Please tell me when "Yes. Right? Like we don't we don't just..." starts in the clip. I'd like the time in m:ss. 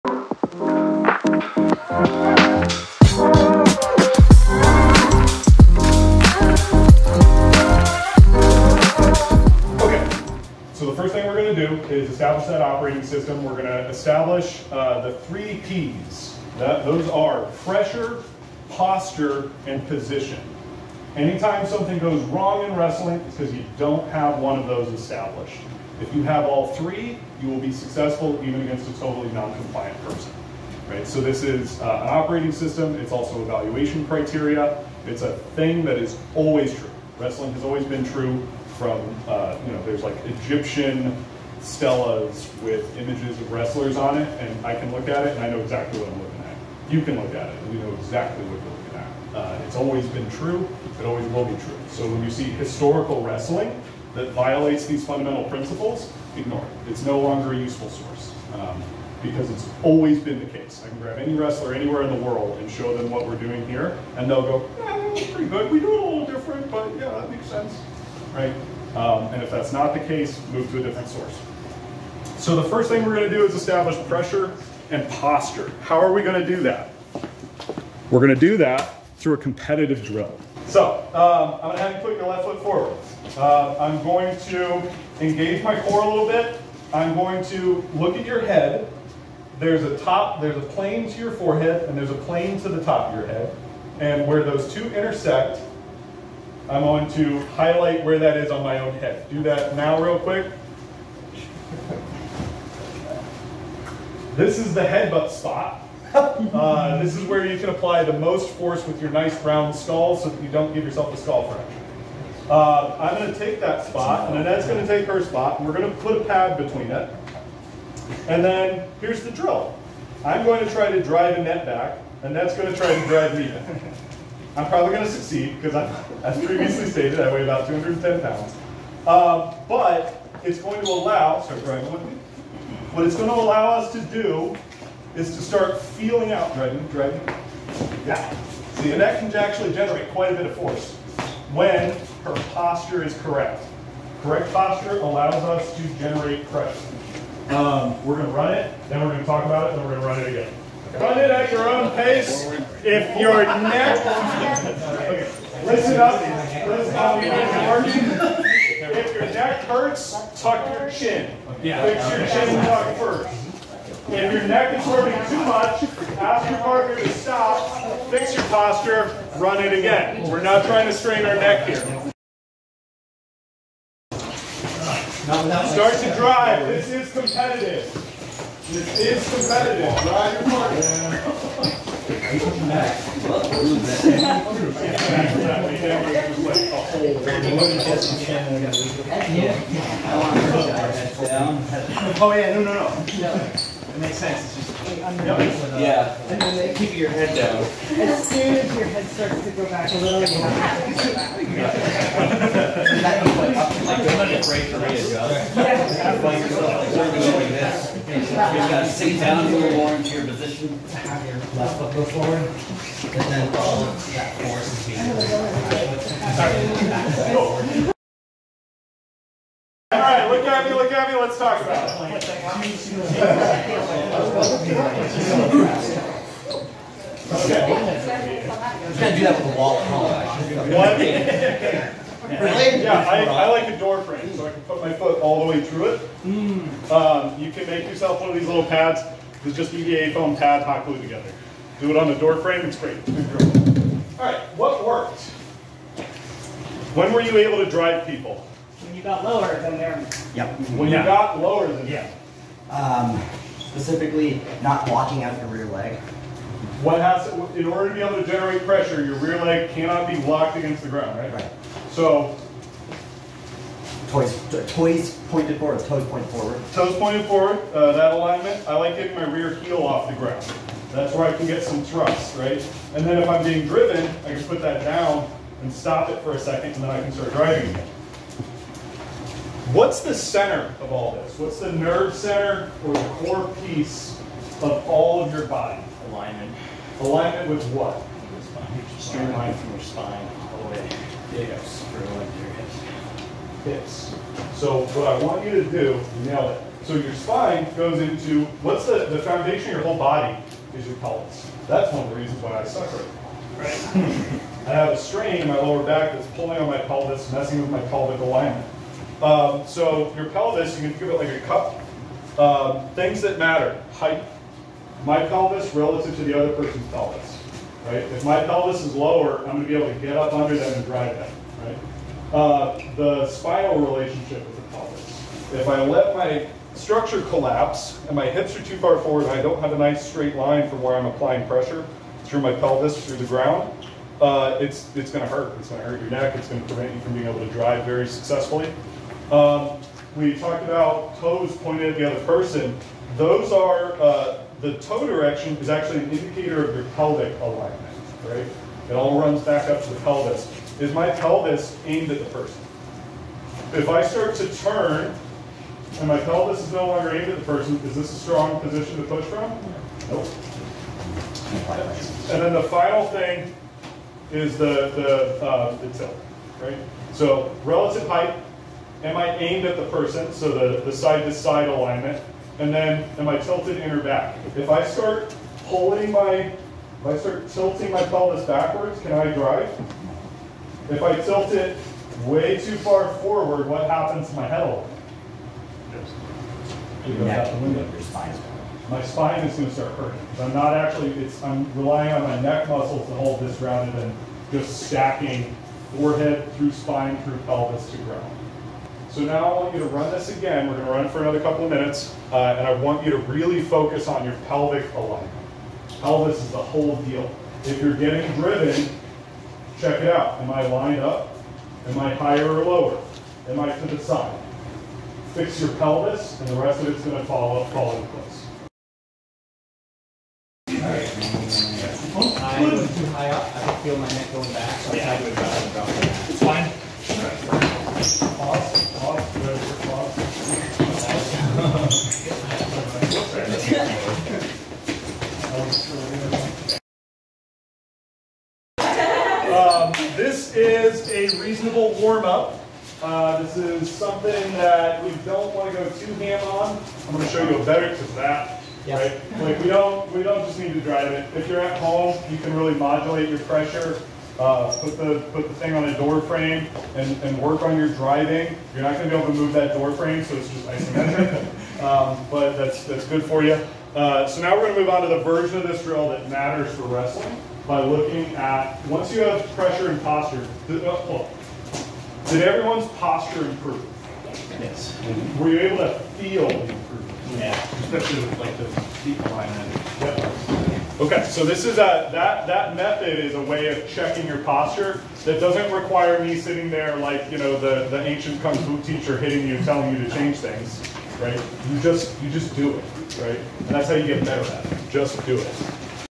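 7:28.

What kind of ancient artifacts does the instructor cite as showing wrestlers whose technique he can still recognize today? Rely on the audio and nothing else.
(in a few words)
Egyptian stelas.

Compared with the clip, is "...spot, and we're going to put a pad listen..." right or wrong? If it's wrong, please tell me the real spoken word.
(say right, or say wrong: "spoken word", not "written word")
wrong: "between", not "listen".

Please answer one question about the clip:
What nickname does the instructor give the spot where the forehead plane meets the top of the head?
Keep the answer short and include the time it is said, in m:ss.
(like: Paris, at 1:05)
The headbutt spot, at 1:44.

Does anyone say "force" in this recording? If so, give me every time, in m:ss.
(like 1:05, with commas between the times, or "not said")
1:48, 2:20, 3:34.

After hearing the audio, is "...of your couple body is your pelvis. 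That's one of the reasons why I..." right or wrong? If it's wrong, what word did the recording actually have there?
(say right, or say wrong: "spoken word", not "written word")
wrong: "whole", not "couple".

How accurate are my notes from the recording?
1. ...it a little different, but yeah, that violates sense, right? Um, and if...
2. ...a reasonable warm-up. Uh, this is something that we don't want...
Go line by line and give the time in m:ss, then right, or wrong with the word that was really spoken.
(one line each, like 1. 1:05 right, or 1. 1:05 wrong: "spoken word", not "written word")
1. 1:05 wrong: "makes", not "violates"
2. 7:21 right.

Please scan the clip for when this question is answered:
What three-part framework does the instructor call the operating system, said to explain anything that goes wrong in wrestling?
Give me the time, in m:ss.
0:15.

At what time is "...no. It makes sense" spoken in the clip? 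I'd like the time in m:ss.
3:12.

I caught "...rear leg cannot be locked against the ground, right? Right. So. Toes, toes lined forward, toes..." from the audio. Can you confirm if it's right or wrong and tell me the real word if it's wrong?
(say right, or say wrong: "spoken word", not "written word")
wrong: "pointed", not "lined".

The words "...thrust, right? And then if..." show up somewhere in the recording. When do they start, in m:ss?
4:31.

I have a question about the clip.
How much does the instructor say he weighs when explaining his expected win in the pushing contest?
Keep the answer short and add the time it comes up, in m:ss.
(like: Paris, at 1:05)
210 pounds, at 2:07.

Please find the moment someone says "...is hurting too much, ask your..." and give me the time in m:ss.
2:44.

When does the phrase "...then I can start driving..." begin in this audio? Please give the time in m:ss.
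4:36.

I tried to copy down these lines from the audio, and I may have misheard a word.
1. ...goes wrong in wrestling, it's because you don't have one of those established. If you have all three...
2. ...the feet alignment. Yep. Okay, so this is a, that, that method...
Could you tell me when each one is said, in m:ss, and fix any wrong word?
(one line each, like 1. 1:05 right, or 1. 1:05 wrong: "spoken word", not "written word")
1. 0:21 right
2. 7:58 right.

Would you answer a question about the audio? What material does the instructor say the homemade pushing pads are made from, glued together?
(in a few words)
EVA foam.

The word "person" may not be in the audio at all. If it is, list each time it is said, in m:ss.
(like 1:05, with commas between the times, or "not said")
0:30, 5:16, 5:42, 5:52, 5:57, 6:09.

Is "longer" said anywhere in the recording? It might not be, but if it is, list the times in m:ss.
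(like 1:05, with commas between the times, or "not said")
0:57, 5:56.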